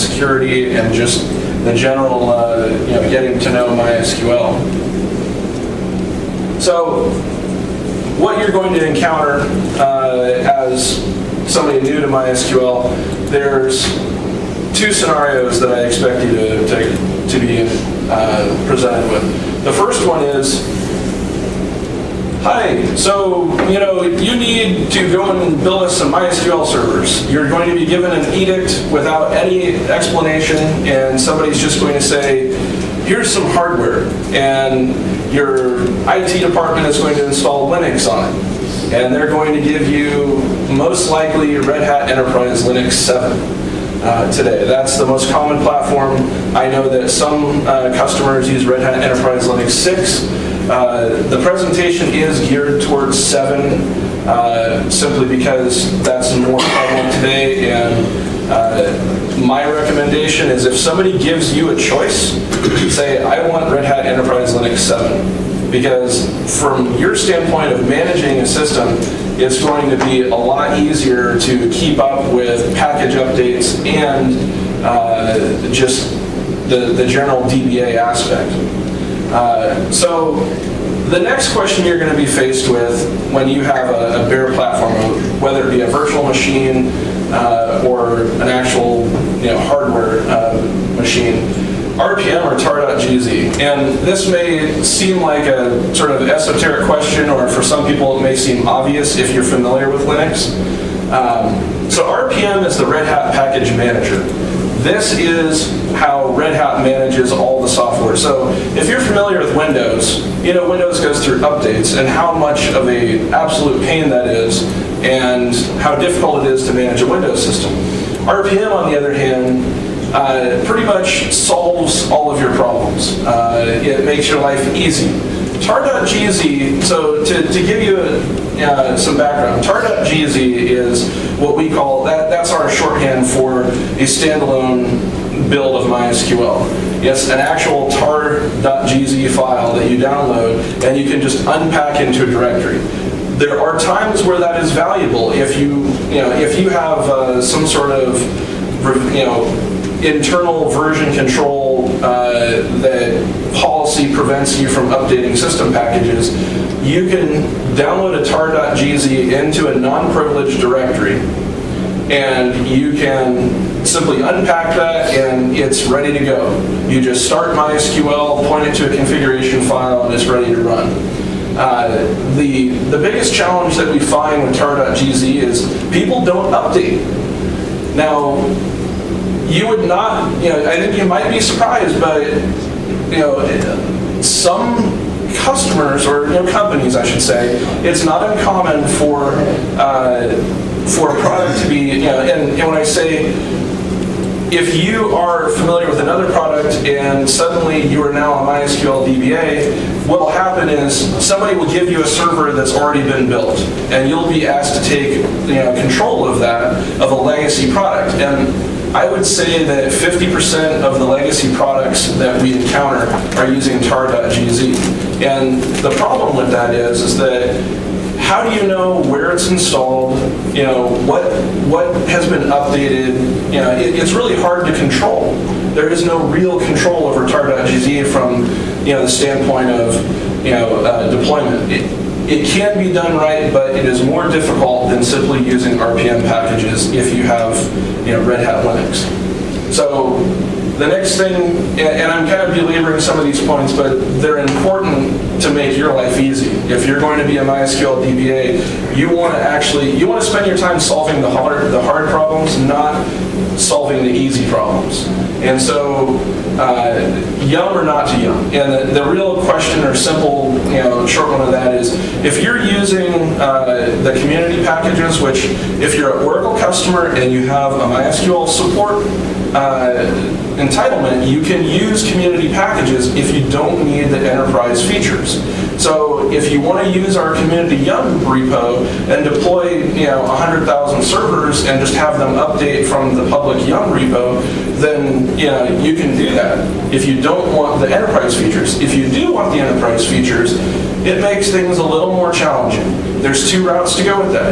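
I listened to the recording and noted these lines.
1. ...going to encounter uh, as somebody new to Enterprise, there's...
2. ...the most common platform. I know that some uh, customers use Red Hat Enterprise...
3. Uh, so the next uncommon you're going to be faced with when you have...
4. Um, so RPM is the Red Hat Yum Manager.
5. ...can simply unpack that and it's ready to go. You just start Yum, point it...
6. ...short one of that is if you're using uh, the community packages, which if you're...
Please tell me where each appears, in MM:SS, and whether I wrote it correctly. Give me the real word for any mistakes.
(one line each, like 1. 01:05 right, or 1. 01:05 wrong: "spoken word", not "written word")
1. 00:08 wrong: "MySQL", not "Enterprise"
2. 00:44 right
3. 01:19 wrong: "question", not "uncommon"
4. 01:41 wrong: "Package", not "Yum"
5. 02:42 wrong: "MySQL", not "Yum"
6. 04:21 right.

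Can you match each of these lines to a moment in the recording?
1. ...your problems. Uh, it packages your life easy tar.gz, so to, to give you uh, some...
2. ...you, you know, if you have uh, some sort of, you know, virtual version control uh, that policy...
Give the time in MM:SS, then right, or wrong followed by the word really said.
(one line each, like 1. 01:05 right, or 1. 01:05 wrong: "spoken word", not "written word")
1. 02:02 wrong: "makes", not "packages"
2. 02:25 wrong: "internal", not "virtual".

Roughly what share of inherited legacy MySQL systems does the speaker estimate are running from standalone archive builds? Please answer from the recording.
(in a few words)
50%.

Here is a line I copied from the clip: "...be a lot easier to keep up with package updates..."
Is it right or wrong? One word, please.
right.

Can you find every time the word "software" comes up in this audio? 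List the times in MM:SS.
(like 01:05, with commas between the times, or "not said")
01:47.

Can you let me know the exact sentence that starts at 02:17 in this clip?
Yes, an actual tar.gz file that you download and you can just unpack into a directory.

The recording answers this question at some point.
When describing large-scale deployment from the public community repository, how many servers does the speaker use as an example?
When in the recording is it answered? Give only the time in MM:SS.
04:40.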